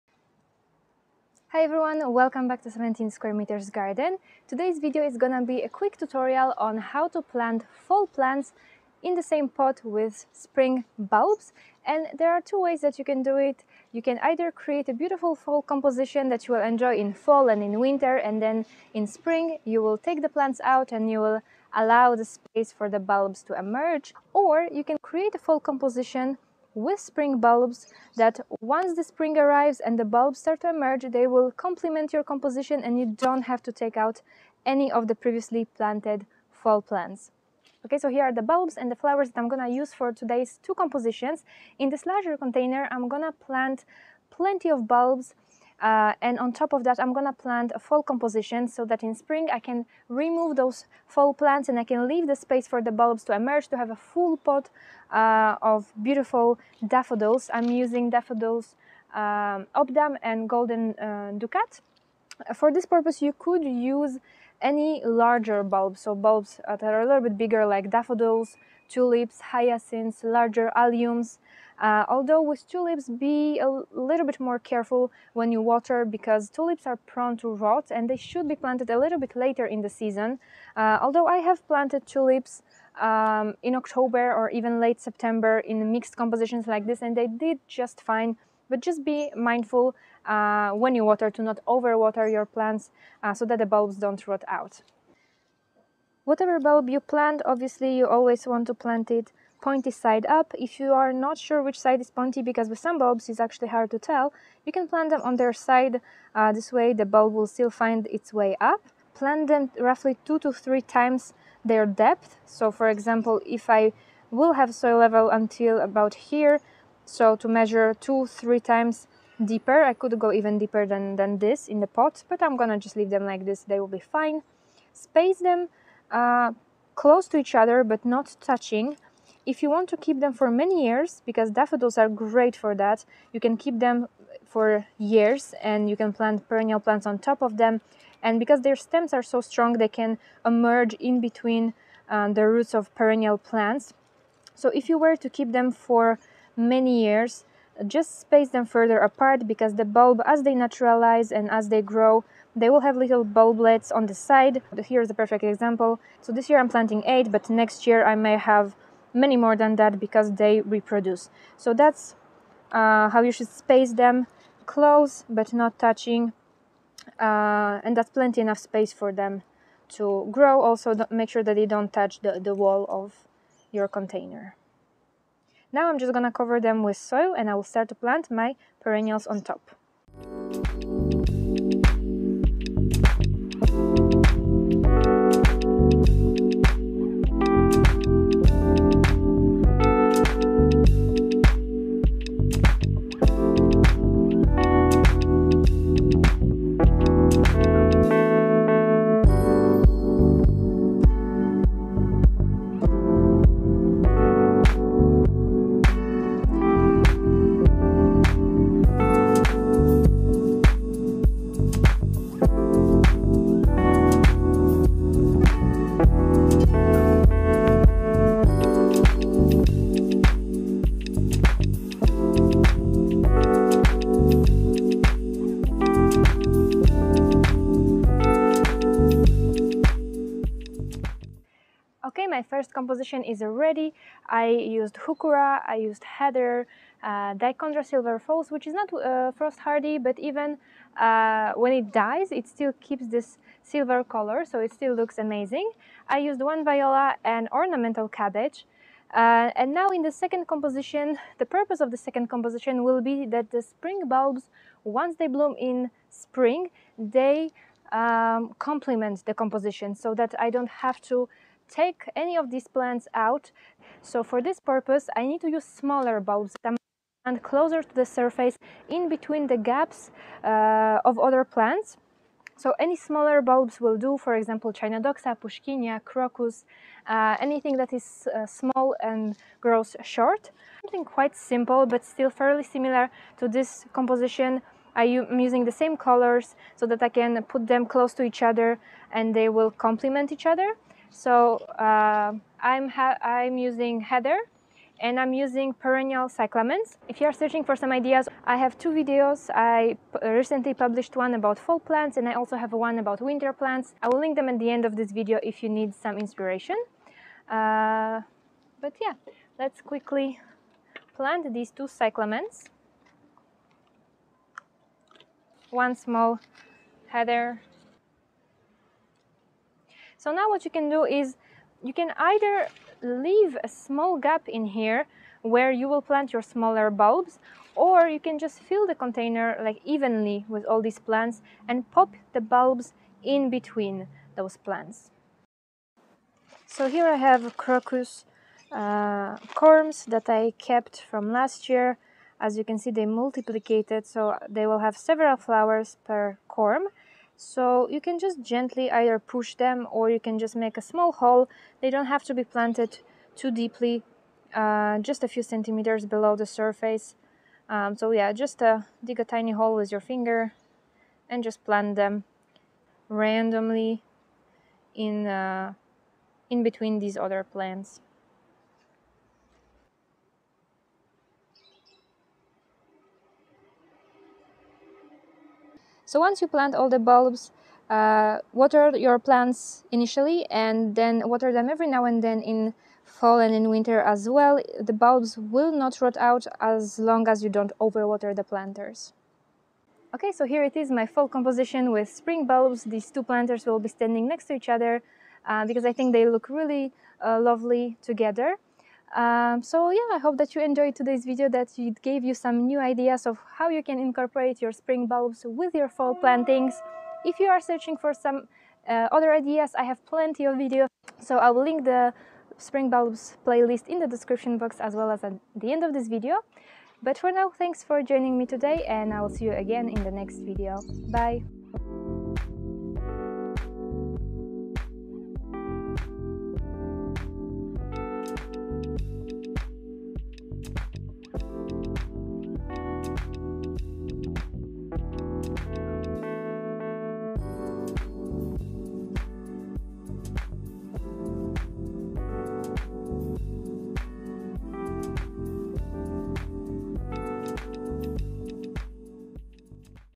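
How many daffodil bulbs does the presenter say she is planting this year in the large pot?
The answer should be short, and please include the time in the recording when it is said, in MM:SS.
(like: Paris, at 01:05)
8, at 02:37.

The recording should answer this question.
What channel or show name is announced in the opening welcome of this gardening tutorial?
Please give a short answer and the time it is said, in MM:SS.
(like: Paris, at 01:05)
17 square meters garden, at 00:02.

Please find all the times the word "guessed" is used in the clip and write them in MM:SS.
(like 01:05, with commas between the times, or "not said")
not said.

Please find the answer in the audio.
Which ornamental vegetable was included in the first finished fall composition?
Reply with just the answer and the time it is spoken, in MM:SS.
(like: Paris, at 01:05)
Ornamental cabbage, at 04:07.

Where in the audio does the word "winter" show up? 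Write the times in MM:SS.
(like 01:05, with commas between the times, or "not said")
00:17, 05:03, 06:23.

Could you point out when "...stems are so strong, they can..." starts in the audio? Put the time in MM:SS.
02:18.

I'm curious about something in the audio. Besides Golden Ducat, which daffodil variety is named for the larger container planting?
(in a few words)
Obdam.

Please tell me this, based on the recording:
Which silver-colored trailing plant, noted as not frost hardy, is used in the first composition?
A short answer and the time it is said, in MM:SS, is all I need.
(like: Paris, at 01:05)
Dichondra Silver Falls, at 03:57.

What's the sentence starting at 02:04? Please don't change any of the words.
Space them uh, close to each other but not touching.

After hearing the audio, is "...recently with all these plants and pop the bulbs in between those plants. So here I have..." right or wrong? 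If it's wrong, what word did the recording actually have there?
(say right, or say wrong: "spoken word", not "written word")
wrong: "evenly", not "recently".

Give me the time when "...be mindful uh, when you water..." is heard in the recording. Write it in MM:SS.
01:29.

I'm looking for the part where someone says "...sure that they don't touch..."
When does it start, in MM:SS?
02:51.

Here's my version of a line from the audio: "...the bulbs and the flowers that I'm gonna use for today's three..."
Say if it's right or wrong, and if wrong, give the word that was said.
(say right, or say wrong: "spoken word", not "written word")
wrong: "two", not "three".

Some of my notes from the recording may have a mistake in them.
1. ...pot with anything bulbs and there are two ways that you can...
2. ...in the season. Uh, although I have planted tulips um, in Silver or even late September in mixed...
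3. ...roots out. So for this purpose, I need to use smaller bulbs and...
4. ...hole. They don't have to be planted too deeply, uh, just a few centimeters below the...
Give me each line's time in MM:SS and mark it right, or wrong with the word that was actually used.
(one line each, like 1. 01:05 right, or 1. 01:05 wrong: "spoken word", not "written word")
1. 00:09 wrong: "spring", not "anything"
2. 01:19 wrong: "October", not "Silver"
3. 04:22 wrong: "plants", not "roots"
4. 05:51 right.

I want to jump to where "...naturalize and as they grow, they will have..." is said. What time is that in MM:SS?
02:30.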